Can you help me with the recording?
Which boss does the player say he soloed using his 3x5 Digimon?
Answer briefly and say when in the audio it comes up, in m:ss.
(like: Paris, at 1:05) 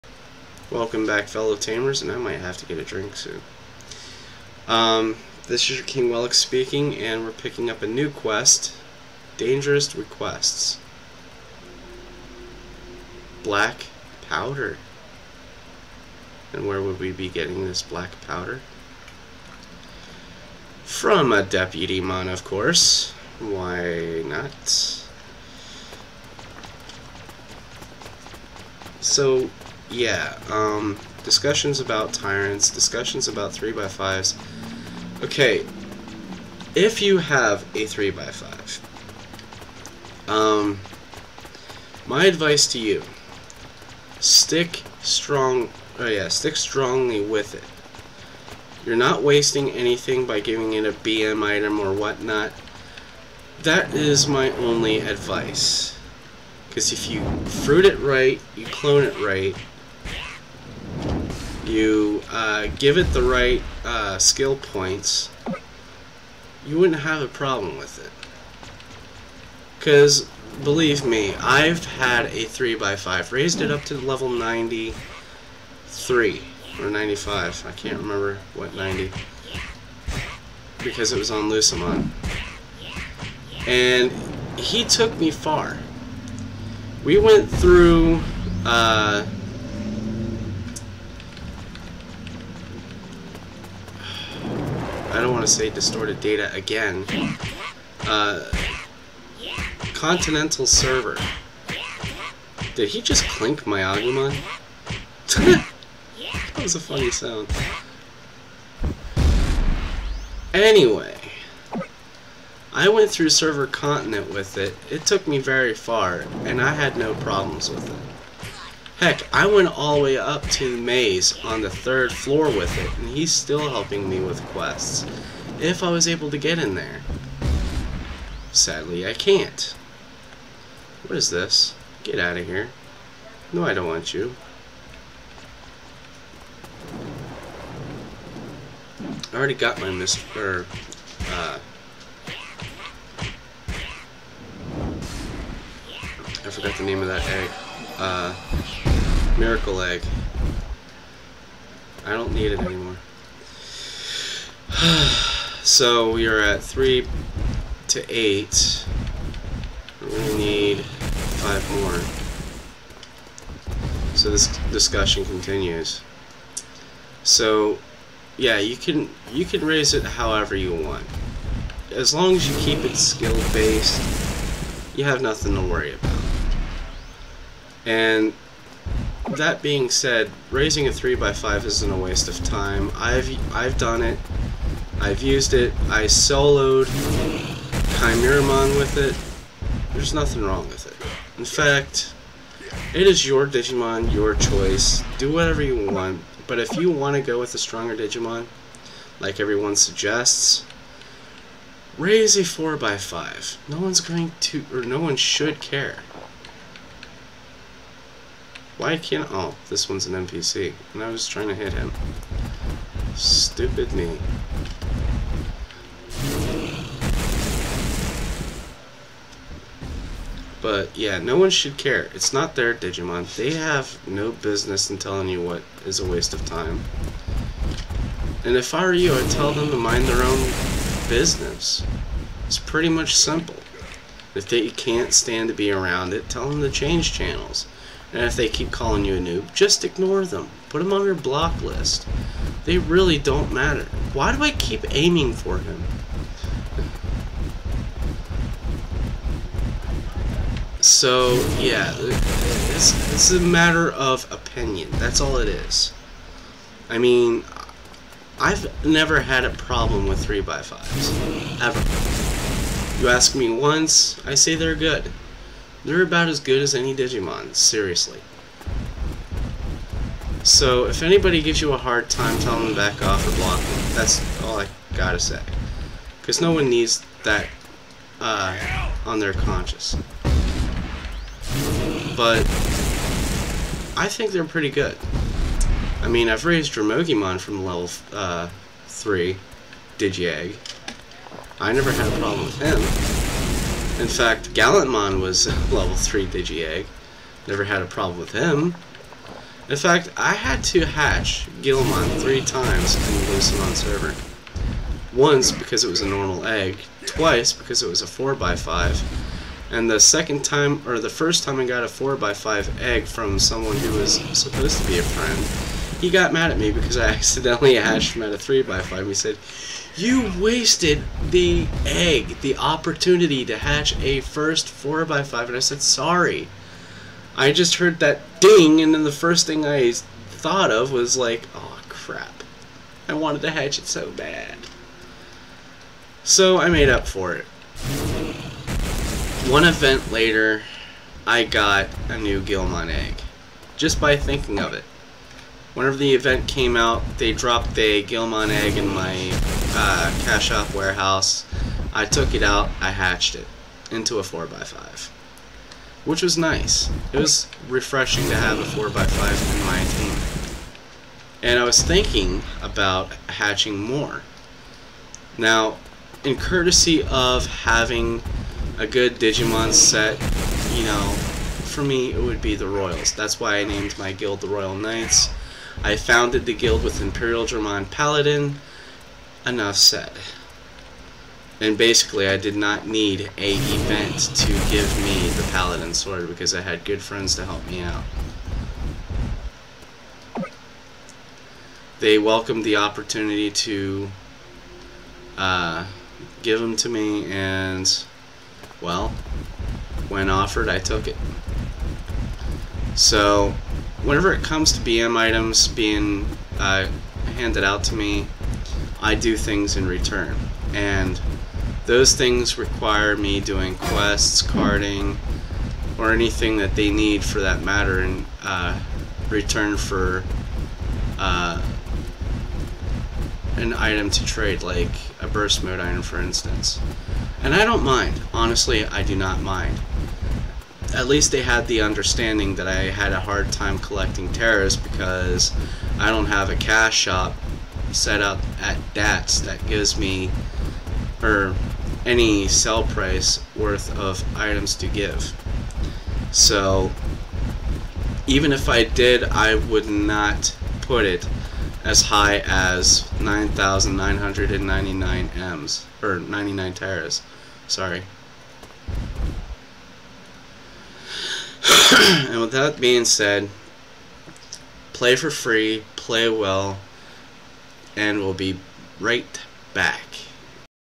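Chimeramon, at 3:07.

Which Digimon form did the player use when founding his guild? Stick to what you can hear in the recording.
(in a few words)
Imperialdramon Paladin.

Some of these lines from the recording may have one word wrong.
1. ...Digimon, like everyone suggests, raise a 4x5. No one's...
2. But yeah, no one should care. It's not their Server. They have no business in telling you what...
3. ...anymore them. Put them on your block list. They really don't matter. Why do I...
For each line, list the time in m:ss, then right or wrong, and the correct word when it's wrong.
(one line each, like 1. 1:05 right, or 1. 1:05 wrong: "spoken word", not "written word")
1. 3:17 right
2. 3:40 wrong: "Digimon", not "Server"
3. 3:59 wrong: "ignore", not "anymore".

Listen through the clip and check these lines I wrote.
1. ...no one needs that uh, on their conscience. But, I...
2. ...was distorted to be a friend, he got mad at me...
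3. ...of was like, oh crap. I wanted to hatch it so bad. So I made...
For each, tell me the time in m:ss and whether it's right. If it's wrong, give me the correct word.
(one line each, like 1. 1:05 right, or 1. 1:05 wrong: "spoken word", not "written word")
1. 4:36 right
2. 5:13 wrong: "supposed", not "distorted"
3. 5:30 right.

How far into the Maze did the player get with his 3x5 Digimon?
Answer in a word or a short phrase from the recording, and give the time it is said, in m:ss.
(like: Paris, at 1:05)
third floor, at 2:01.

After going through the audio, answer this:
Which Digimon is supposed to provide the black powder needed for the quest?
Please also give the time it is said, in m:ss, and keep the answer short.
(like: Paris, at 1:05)
Deputymon, at 0:21.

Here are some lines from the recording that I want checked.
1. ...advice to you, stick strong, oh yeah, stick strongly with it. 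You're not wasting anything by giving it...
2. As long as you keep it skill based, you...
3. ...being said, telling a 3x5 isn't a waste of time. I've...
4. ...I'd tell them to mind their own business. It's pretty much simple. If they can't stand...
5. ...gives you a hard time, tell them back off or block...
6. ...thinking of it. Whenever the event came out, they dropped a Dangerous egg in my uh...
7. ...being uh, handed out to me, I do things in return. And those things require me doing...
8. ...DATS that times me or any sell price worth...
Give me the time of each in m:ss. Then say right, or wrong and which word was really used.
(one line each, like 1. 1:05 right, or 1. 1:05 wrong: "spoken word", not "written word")
1. 0:42 right
2. 2:51 right
3. 2:59 wrong: "raising", not "telling"
4. 3:49 right
5. 4:31 right
6. 5:44 wrong: "Guilmon", not "Dangerous"
7. 6:45 right
8. 7:18 wrong: "gives", not "times".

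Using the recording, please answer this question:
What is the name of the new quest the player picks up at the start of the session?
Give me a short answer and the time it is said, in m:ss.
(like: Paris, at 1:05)
Dangerous Requests, at 0:09.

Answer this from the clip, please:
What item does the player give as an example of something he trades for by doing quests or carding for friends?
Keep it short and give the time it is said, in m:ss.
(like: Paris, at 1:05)
burst mode iron, at 7:05.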